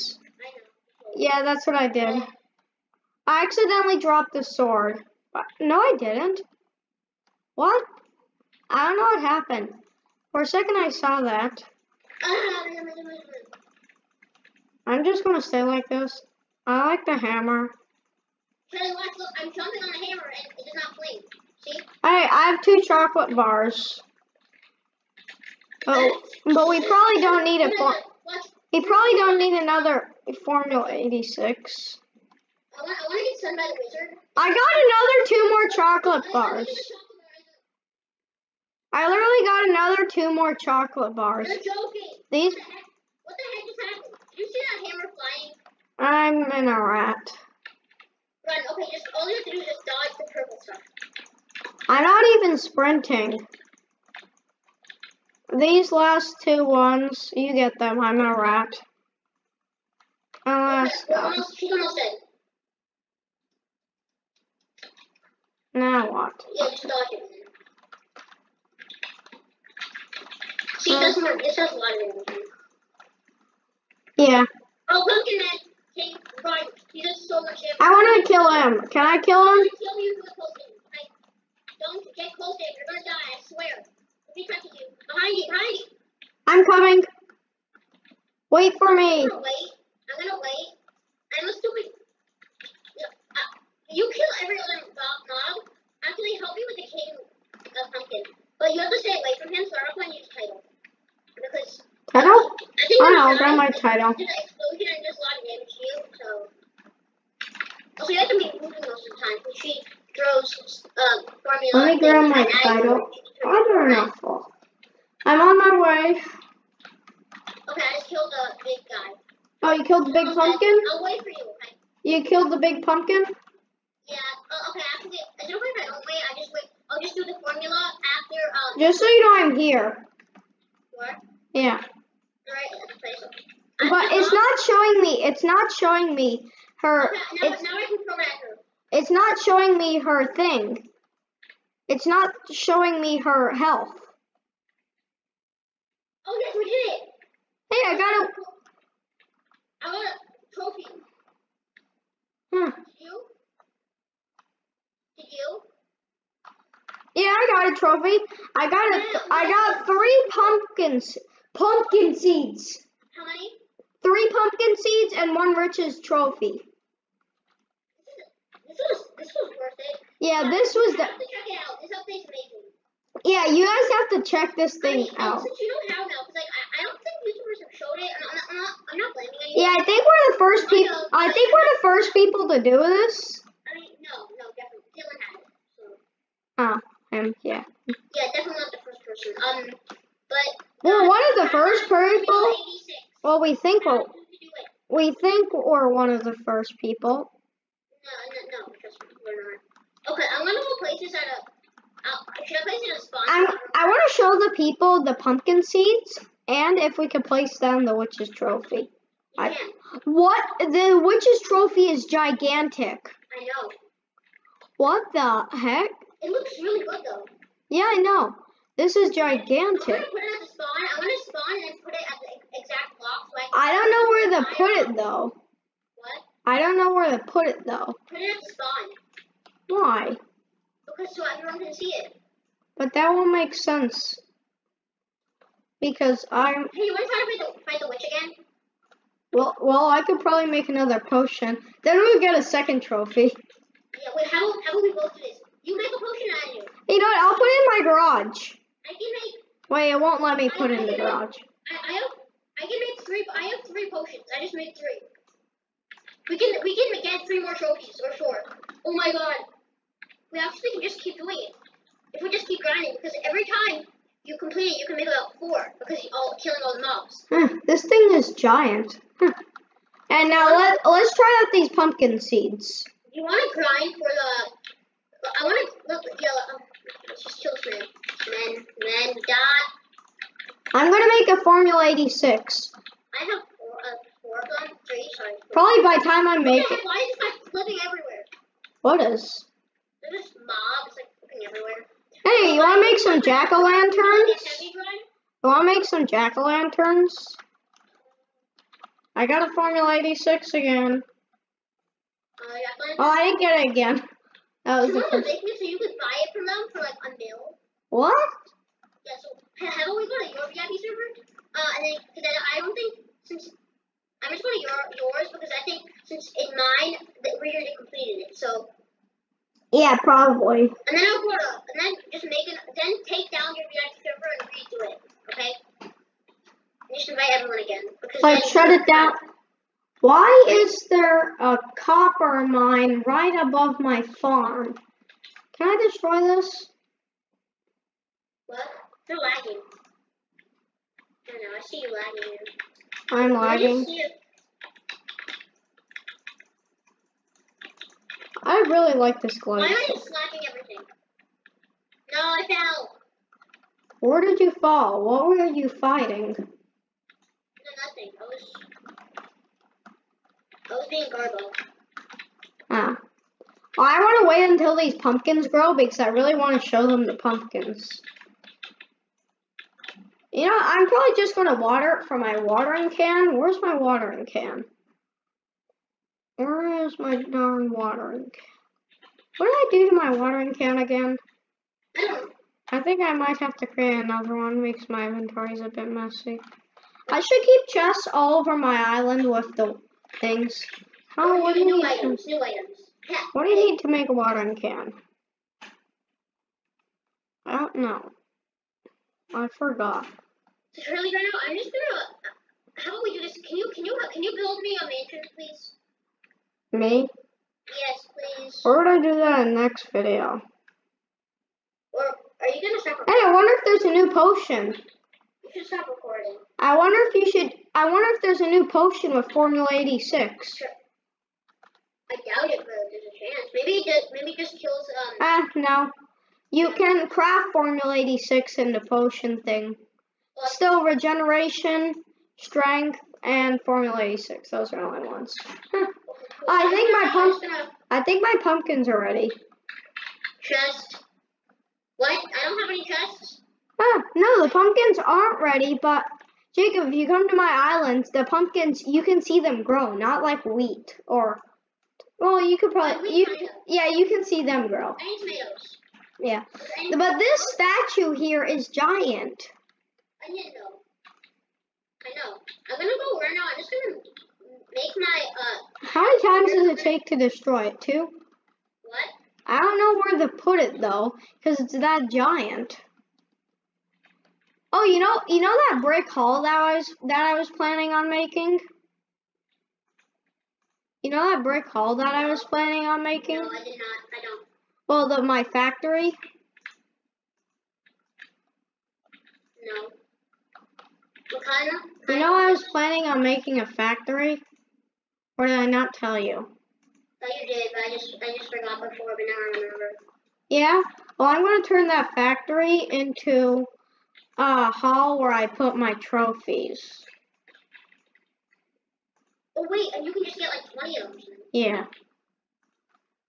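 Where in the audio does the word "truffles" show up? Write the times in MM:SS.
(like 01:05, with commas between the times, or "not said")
not said.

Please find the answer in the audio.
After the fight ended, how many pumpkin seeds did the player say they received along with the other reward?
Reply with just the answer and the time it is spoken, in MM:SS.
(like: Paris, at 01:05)
3, at 02:44.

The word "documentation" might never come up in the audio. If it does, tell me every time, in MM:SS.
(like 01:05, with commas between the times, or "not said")
not said.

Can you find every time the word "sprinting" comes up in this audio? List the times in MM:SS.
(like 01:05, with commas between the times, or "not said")
00:52.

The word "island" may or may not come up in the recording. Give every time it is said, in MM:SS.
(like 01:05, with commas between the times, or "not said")
06:28, 07:27.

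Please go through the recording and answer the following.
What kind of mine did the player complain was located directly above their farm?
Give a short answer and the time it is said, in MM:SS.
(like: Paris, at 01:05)
copper mine, at 05:31.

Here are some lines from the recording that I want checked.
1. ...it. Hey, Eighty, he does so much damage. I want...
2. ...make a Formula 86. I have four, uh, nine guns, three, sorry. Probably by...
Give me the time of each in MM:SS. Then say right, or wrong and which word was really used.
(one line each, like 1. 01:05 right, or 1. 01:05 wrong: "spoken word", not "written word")
1. 01:15 wrong: "Brian", not "Eighty"
2. 04:41 wrong: "four", not "nine".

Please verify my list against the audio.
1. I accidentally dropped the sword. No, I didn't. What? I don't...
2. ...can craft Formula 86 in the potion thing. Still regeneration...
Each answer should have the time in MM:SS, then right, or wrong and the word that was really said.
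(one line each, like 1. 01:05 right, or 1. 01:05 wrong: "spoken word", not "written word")
1. 00:03 right
2. 07:06 right.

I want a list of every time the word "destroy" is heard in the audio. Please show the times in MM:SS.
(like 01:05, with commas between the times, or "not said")
05:35, 07:47.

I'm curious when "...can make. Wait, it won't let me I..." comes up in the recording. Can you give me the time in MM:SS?
04:08.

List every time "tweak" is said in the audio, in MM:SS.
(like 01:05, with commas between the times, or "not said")
not said.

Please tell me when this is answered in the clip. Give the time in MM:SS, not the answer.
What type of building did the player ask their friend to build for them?
06:44.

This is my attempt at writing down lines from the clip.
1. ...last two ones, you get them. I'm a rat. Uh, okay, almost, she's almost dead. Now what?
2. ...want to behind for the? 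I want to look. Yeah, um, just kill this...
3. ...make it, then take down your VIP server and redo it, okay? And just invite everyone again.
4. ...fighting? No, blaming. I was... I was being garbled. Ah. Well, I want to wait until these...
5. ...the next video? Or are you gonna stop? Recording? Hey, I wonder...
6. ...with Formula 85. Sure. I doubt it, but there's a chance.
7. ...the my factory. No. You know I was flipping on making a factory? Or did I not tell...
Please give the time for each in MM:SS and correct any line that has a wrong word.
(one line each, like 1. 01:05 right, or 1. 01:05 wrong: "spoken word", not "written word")
1. 00:55 right
2. 04:33 wrong: "grind", not "behind"
3. 05:22 right
4. 05:55 wrong: "nothing", not "blaming"
5. 06:49 right
6. 06:59 wrong: "86", not "85"
7. 08:05 wrong: "planning", not "flipping".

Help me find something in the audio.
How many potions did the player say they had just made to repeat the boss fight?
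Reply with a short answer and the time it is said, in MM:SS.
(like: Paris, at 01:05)
3, at 04:13.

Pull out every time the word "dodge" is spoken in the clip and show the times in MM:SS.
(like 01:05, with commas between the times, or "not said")
00:49, 01:06.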